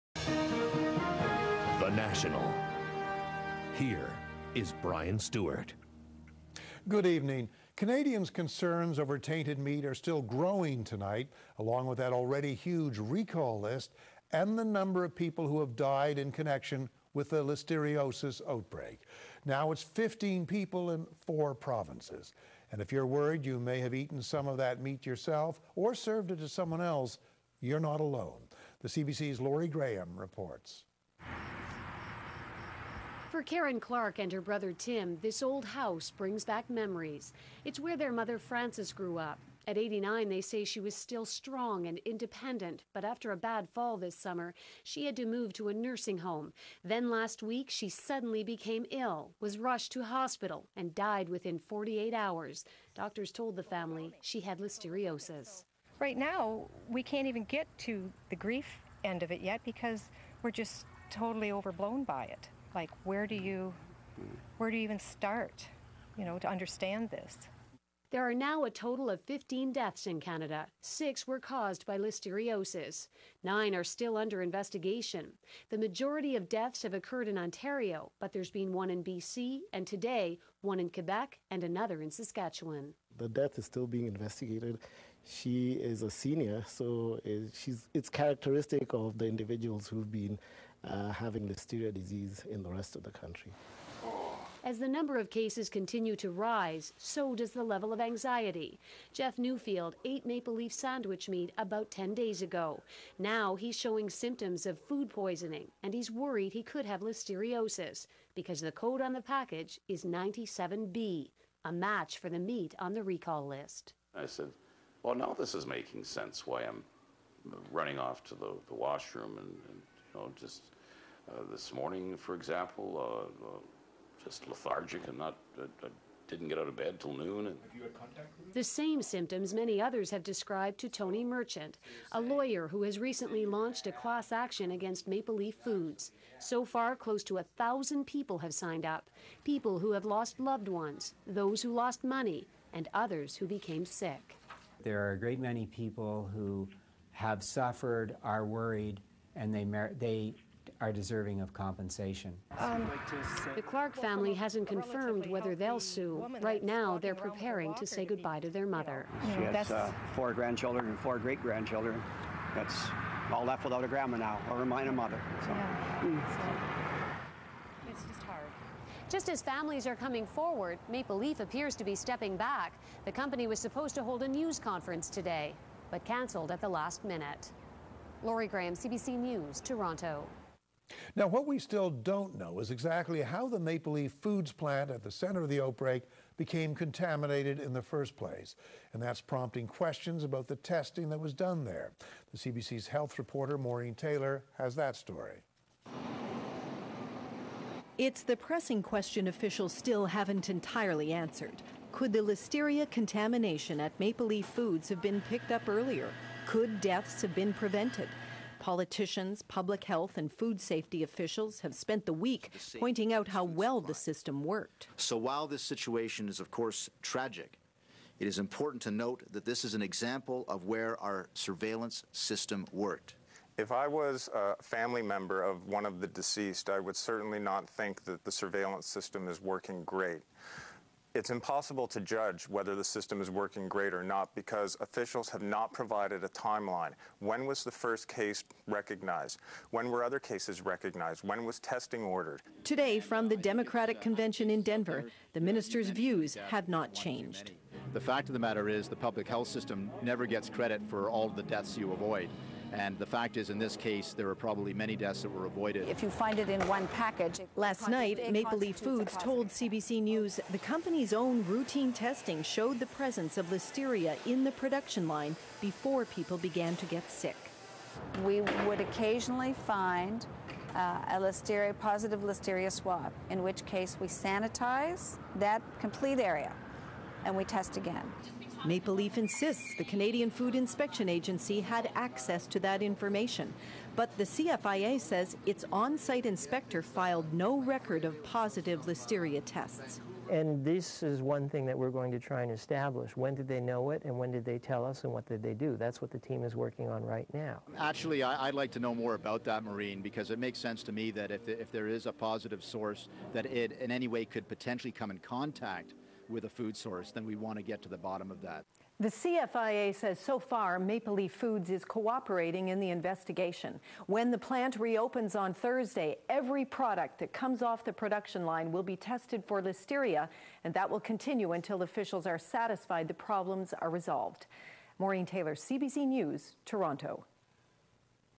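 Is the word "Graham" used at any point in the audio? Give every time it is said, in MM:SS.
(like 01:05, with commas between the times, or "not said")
00:29, 02:58.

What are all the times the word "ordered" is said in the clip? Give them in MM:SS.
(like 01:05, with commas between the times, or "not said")
04:02.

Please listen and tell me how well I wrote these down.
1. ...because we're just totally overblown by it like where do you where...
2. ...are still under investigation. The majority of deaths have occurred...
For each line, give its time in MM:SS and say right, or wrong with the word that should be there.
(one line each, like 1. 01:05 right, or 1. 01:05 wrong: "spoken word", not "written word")
1. 00:59 right
2. 01:13 right.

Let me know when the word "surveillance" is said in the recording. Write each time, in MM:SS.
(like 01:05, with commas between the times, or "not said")
03:41, 03:48.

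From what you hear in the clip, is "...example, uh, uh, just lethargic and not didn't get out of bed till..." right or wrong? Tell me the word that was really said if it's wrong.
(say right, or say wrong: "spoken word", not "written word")
right.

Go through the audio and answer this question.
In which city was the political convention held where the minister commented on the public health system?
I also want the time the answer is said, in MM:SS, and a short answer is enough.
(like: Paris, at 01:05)
Denver, at 04:04.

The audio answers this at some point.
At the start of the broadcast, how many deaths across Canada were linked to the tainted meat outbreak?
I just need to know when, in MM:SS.
00:19.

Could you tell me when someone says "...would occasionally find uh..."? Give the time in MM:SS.
04:28.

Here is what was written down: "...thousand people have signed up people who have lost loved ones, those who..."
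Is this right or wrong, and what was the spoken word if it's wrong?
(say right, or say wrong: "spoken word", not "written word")
right.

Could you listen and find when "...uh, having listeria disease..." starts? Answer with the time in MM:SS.
01:30.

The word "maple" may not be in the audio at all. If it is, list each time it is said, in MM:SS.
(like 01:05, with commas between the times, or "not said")
01:40, 02:15, 02:50, 03:03, 03:23, 04:18, 04:38, 05:10.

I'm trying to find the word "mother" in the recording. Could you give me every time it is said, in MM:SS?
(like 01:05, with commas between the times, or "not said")
00:38, 02:38, 02:44.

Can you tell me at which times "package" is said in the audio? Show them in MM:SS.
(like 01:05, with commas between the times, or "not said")
01:49, 04:16.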